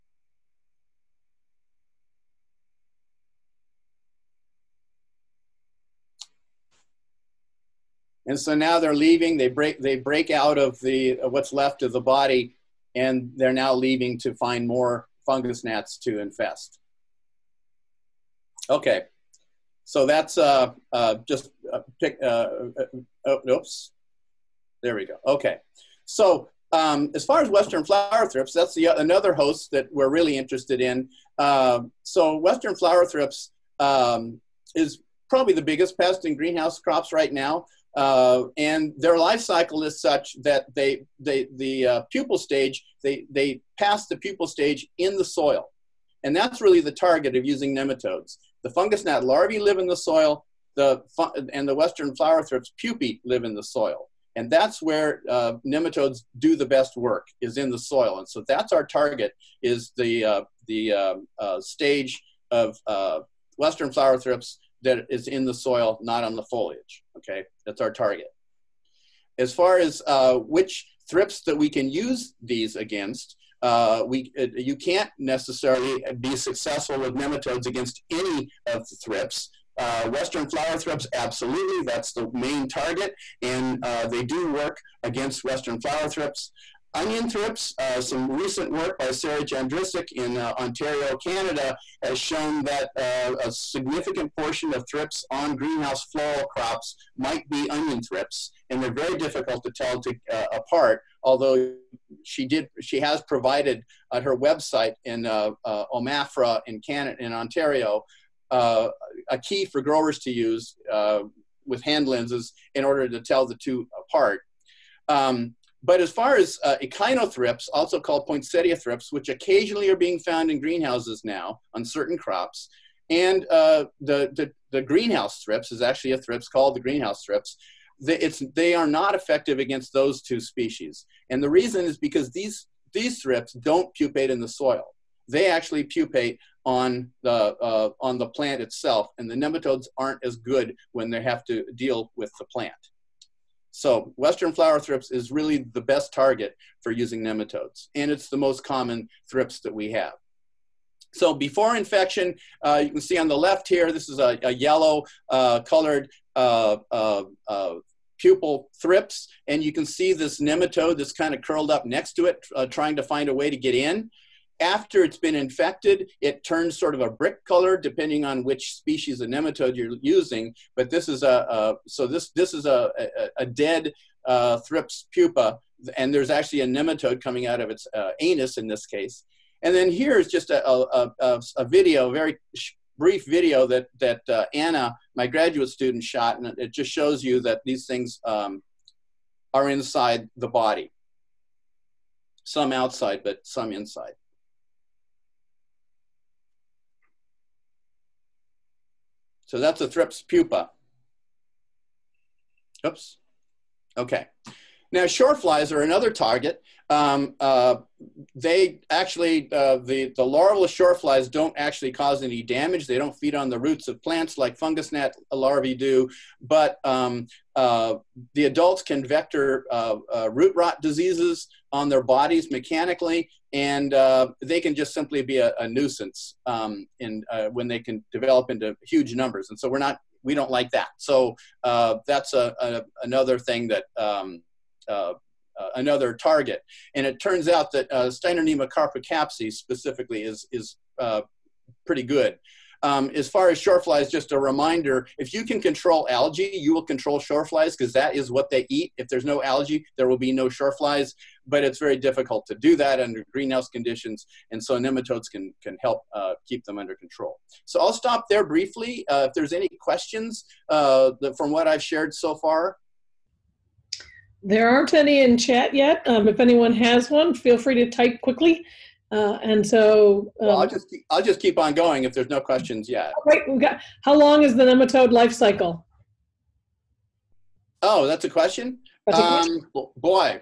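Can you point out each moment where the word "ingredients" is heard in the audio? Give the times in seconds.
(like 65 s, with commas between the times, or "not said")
not said.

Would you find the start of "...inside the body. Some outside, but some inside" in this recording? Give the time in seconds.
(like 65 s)
189 s.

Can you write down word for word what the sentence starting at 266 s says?
Um, if anyone has one, feel free to type quickly.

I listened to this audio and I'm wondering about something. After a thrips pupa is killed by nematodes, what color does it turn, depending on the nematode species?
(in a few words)
brick color.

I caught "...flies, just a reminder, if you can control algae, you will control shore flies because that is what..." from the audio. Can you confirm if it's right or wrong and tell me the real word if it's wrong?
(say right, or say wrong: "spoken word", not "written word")
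right.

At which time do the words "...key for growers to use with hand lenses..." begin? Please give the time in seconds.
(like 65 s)
109 s.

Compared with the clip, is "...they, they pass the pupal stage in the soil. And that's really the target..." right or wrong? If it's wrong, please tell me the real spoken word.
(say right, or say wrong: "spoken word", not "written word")
right.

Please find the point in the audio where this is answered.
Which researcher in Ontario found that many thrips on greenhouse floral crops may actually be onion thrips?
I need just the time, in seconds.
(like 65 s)
89 s.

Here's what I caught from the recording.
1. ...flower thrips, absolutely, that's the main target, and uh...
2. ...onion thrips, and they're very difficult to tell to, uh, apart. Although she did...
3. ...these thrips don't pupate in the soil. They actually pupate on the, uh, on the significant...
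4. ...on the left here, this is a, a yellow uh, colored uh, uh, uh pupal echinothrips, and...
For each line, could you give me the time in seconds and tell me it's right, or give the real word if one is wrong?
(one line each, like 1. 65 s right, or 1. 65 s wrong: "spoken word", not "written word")
1. 80 s right
2. 97 s right
3. 132 s wrong: "plant", not "significant"
4. 153 s wrong: "thrips", not "echinothrips".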